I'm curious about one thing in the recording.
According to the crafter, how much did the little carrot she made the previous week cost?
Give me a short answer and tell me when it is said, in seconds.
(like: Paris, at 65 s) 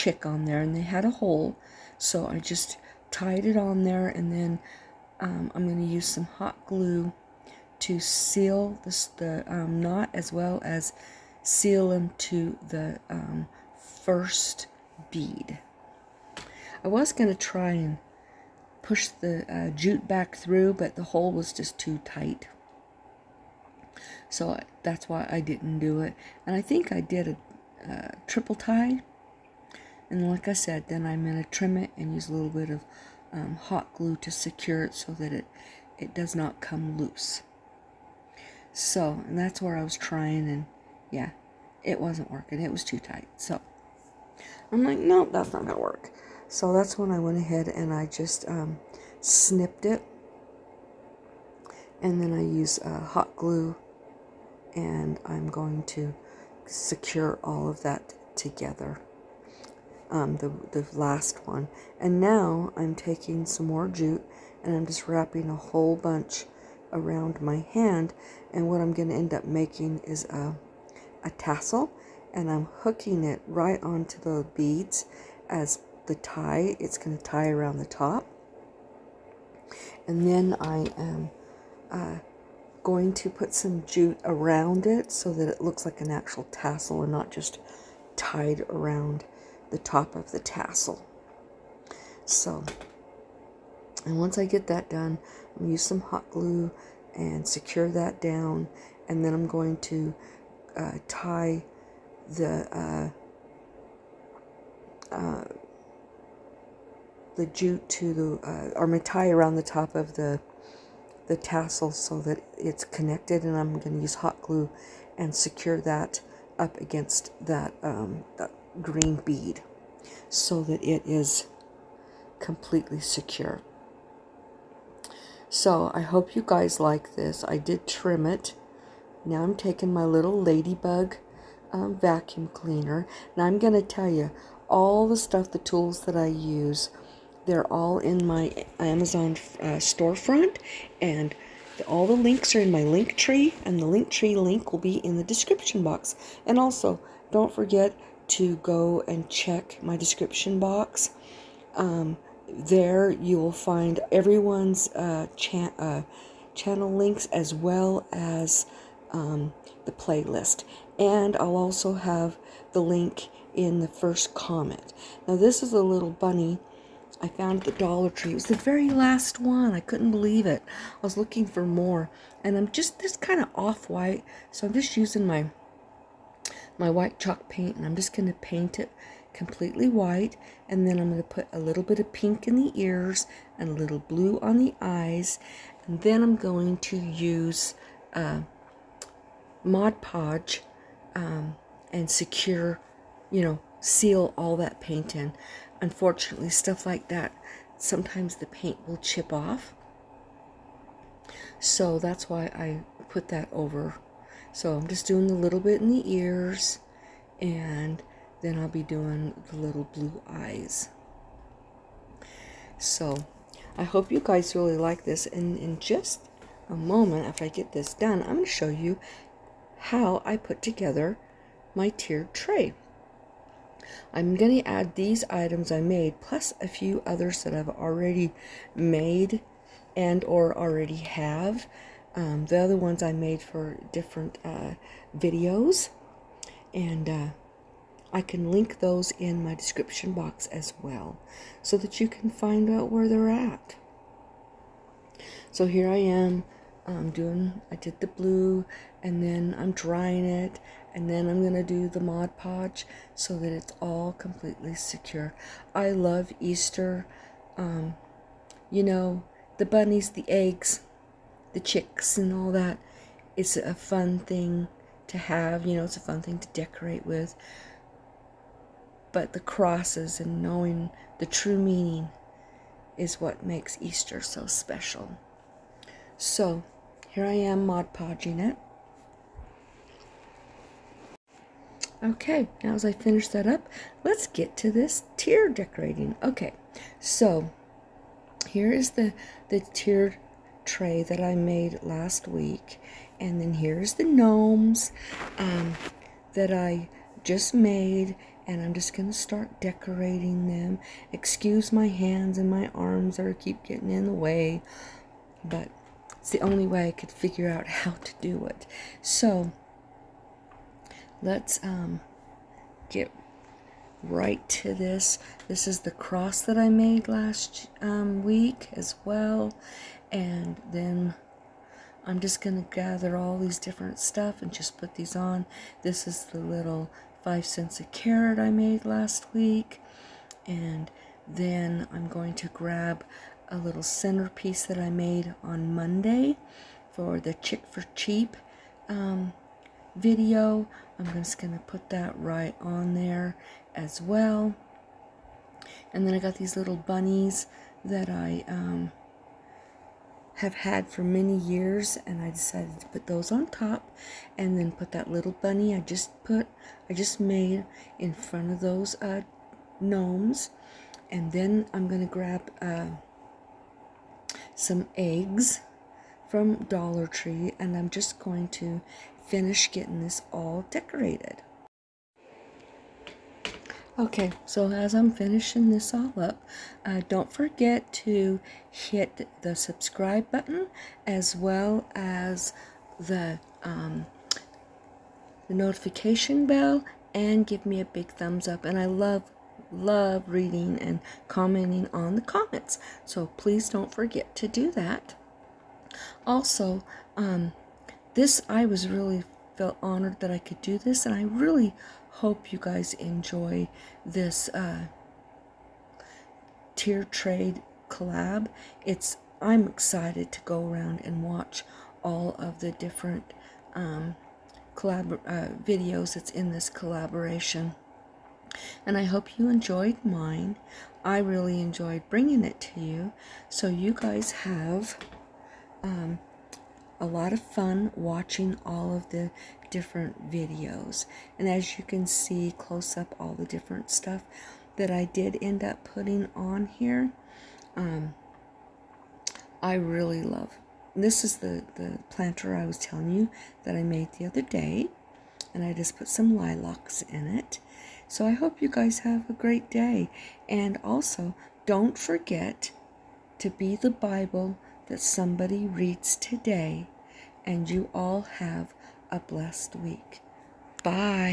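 5 cents, at 327 s.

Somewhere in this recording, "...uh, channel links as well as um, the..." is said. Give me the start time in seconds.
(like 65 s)
155 s.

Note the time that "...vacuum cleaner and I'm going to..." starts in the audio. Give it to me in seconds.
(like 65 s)
131 s.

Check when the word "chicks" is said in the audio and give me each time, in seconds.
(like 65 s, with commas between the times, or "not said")
261 s, 337 s.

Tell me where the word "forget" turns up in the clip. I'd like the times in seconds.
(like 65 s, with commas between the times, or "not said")
147 s, 377 s, 393 s, 451 s.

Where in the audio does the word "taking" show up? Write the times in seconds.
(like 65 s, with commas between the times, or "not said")
62 s, 129 s.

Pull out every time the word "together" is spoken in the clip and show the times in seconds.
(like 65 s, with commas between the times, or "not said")
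58 s, 220 s.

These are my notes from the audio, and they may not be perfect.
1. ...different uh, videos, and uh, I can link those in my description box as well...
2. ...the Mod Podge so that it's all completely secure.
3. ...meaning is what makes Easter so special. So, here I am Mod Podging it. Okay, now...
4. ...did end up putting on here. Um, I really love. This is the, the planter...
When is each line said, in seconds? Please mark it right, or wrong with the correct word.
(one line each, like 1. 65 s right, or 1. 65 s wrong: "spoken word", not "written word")
1. 233 s right
2. 251 s right
3. 271 s right
4. 435 s right.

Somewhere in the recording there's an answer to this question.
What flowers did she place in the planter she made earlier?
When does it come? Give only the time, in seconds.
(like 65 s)
446 s.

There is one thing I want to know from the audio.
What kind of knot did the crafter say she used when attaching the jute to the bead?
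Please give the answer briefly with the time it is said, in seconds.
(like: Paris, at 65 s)
Triple tie, at 28 s.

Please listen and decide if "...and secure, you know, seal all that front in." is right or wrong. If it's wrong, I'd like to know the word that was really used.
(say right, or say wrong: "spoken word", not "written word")
wrong: "paint", not "front".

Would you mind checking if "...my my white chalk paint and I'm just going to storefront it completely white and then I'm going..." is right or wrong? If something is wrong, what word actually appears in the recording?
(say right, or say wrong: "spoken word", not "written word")
wrong: "paint", not "storefront".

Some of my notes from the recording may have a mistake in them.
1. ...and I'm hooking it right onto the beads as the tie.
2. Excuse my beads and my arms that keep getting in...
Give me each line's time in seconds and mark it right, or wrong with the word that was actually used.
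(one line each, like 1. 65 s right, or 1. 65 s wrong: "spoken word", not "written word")
1. 72 s right
2. 301 s wrong: "hands", not "beads".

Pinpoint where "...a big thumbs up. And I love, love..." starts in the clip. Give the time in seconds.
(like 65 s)
387 s.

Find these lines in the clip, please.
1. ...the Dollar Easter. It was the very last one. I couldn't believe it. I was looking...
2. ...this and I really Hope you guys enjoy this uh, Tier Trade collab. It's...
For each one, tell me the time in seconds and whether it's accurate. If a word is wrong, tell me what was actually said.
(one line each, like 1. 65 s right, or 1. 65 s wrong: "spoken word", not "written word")
1. 167 s wrong: "Tree", not "Easter"
2. 400 s right.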